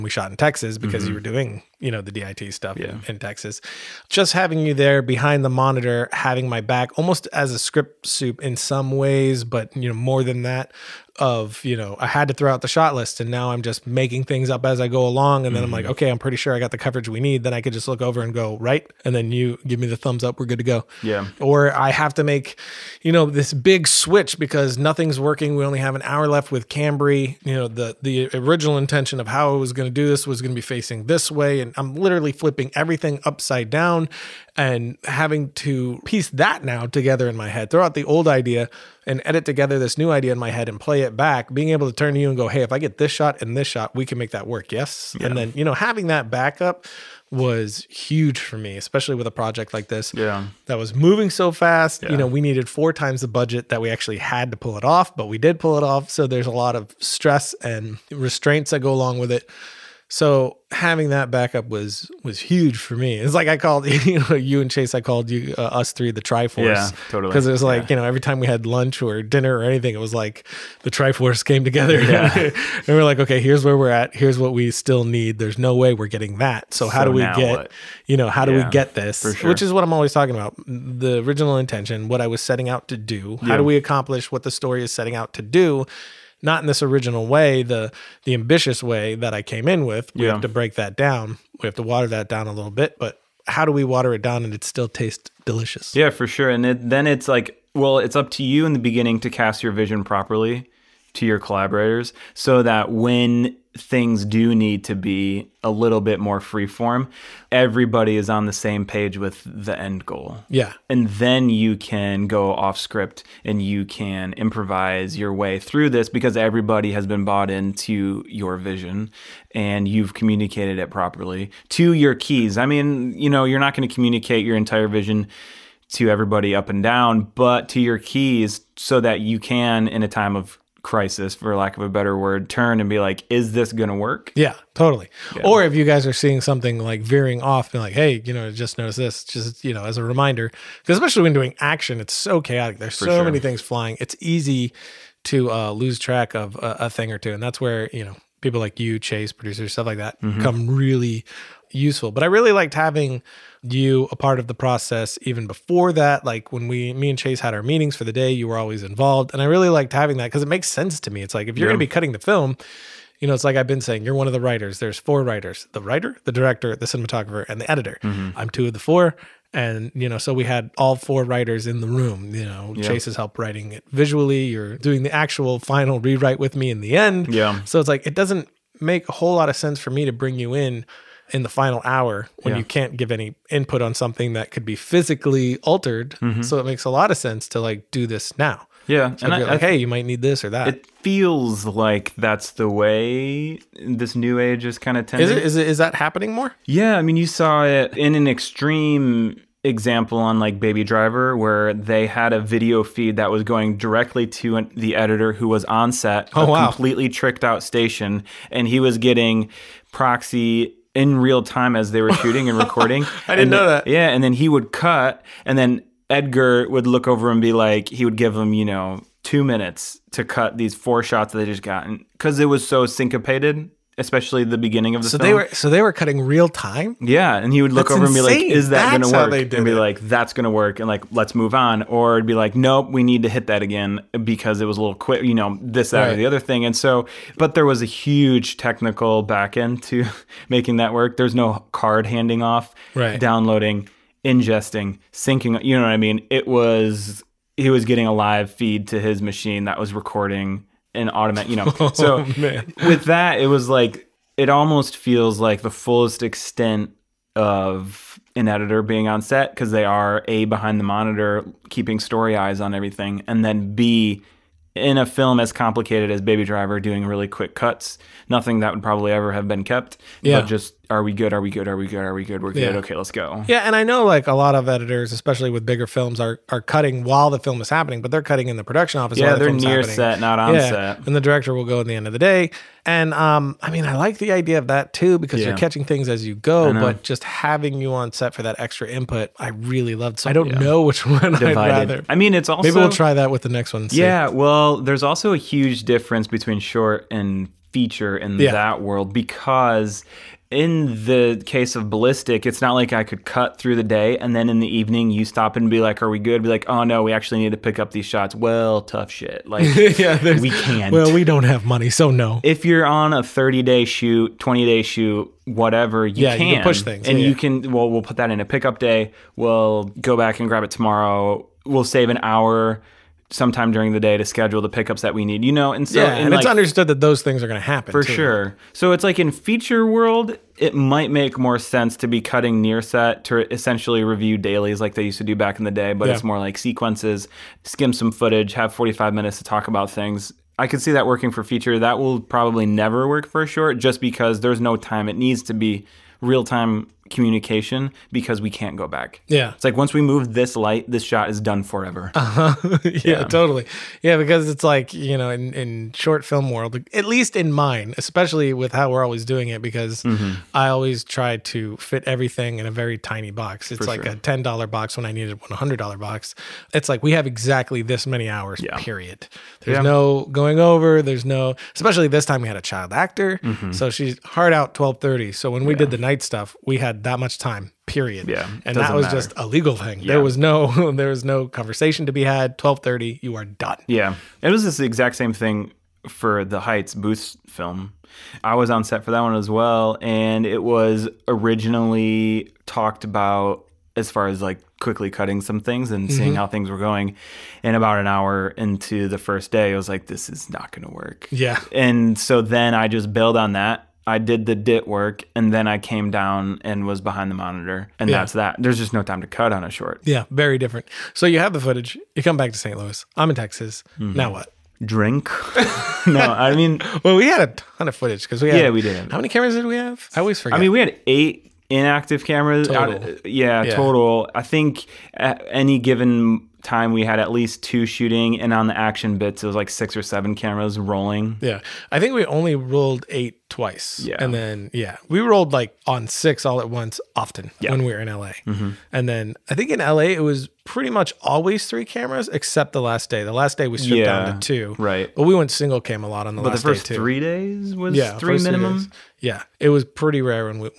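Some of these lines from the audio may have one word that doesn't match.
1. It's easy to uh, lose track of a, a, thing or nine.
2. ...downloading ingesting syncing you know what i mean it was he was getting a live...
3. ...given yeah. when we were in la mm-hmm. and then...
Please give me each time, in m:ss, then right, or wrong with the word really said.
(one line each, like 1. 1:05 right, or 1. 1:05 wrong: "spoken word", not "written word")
1. 2:23 wrong: "two", not "nine"
2. 4:03 right
3. 7:17 wrong: "often", not "given".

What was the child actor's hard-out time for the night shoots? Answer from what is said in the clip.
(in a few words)
12:30.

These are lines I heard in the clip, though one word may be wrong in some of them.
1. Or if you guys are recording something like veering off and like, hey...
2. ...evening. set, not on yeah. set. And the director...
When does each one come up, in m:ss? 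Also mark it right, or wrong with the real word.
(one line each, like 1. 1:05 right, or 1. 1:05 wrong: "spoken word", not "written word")
1. 2:15 wrong: "seeing", not "recording"
2. 4:39 wrong: "happening", not "evening".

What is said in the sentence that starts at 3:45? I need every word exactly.
they were so they were cutting real time yeah and he would look that's over insane.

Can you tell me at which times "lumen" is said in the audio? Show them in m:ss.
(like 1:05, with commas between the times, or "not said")
not said.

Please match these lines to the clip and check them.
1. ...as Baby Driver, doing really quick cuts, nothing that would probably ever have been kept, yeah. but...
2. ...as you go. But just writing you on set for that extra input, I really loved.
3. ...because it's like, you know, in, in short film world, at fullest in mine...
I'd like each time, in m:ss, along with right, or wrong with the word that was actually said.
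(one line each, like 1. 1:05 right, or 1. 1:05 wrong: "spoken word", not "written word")
1. 4:26 right
2. 4:46 wrong: "having", not "writing"
3. 5:54 wrong: "least", not "fullest".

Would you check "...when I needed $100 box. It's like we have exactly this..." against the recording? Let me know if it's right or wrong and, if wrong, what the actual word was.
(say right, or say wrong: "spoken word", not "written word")
right.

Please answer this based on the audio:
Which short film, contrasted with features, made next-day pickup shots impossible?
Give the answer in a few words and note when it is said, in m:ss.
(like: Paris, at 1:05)
Ballistic, at 5:01.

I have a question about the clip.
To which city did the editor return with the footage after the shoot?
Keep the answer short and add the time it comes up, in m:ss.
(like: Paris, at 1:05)
St. Louis, at 6:52.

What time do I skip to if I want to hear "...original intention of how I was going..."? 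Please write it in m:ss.
0:28.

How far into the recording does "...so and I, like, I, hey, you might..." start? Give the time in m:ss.
3:09.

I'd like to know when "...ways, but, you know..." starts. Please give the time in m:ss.
0:08.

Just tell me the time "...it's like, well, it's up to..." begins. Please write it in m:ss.
1:37.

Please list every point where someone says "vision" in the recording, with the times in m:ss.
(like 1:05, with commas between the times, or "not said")
1:39, 1:58, 2:04.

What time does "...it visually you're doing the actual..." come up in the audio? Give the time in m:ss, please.
2:53.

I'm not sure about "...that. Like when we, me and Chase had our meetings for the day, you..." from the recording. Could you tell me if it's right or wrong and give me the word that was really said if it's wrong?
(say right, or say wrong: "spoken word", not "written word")
right.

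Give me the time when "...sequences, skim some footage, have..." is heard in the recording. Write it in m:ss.
5:36.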